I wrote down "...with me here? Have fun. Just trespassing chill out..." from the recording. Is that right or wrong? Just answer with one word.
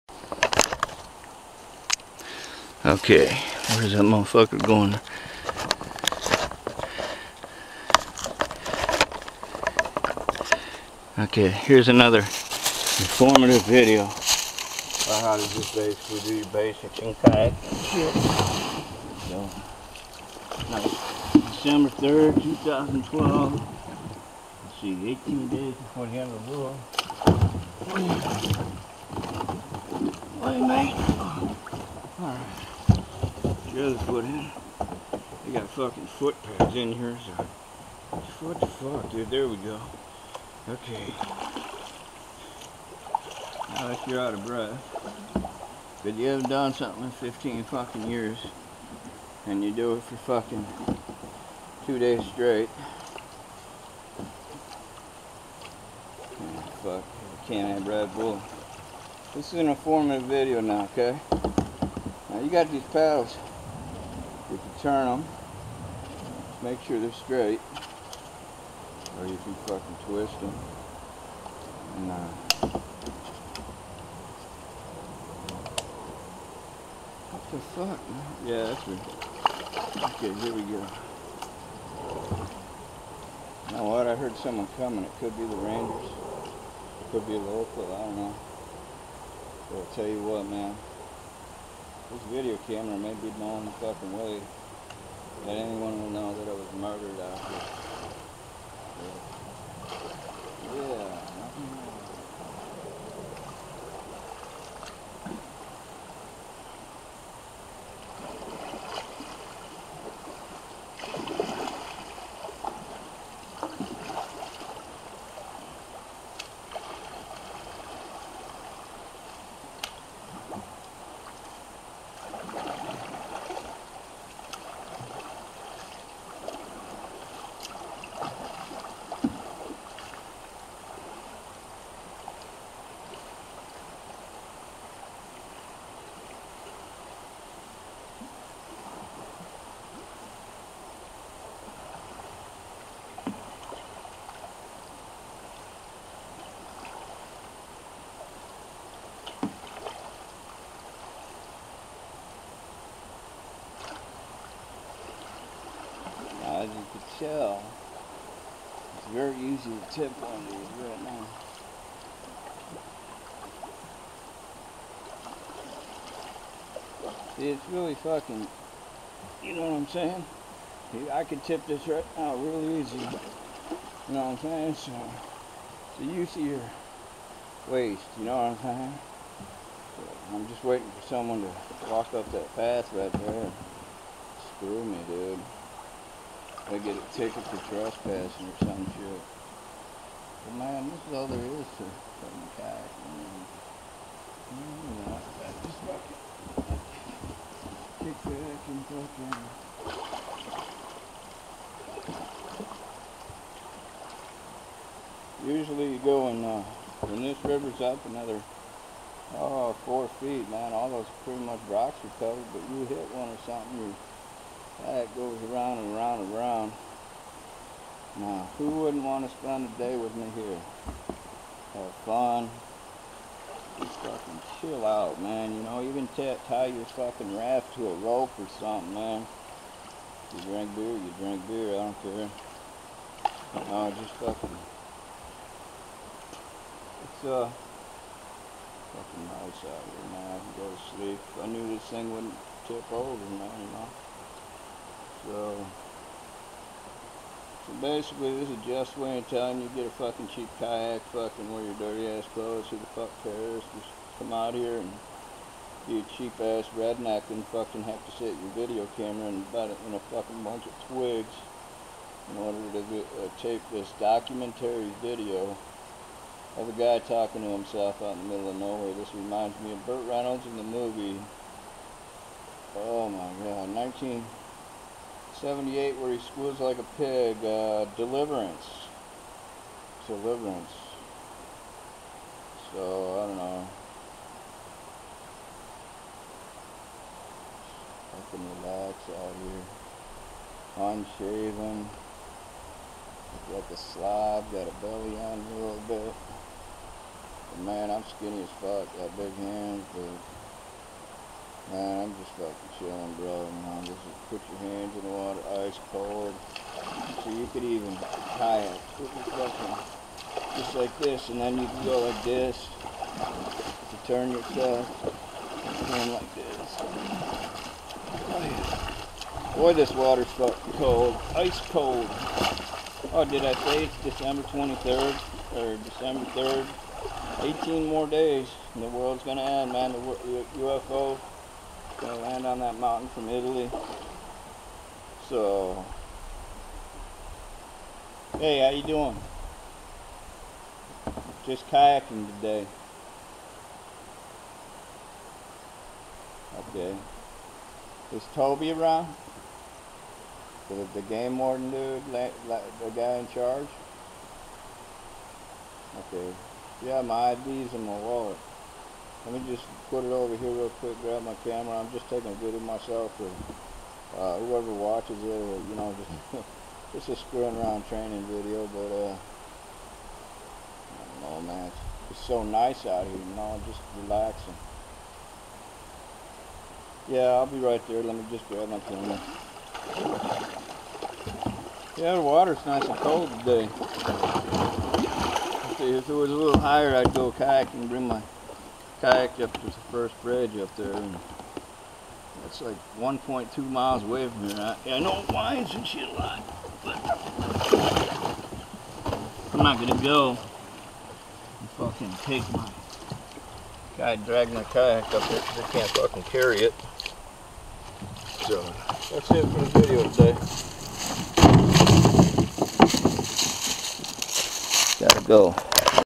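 wrong.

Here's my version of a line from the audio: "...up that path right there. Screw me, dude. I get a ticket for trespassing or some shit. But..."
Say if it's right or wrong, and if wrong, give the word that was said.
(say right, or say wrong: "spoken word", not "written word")
right.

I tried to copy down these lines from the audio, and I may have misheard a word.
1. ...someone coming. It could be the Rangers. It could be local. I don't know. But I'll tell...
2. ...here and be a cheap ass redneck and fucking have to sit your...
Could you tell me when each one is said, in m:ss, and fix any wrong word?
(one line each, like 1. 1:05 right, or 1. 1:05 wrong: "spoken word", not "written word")
1. 1:24 right
2. 4:14 right.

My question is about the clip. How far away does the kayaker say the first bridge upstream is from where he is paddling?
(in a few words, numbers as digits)
1.2 miles.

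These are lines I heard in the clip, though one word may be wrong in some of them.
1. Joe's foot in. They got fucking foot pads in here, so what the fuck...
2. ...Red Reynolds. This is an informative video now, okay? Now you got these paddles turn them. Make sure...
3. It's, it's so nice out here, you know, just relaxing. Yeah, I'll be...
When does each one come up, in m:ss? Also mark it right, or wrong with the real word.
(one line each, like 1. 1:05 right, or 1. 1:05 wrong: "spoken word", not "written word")
1. 0:33 right
2. 0:57 wrong: "Bull", not "Reynolds"
3. 6:11 right.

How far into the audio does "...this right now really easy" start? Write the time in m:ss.
2:51.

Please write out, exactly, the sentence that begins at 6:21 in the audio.
Yeah, the water's nice and cold today.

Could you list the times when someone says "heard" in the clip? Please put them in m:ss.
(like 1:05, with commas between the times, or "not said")
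1:24.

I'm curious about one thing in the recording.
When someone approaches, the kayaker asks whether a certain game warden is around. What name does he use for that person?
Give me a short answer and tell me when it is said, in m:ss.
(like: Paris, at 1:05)
Toby, at 5:48.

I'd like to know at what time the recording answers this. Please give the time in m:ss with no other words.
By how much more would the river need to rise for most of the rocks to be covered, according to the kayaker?
3:29.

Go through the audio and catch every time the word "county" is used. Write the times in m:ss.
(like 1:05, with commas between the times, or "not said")
not said.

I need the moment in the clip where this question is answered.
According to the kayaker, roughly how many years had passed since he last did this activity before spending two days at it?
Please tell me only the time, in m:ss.
0:47.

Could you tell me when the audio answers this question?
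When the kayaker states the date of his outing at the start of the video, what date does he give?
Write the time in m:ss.
0:21.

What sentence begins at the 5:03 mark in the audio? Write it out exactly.
Man, just put your hands in the water, ice cold.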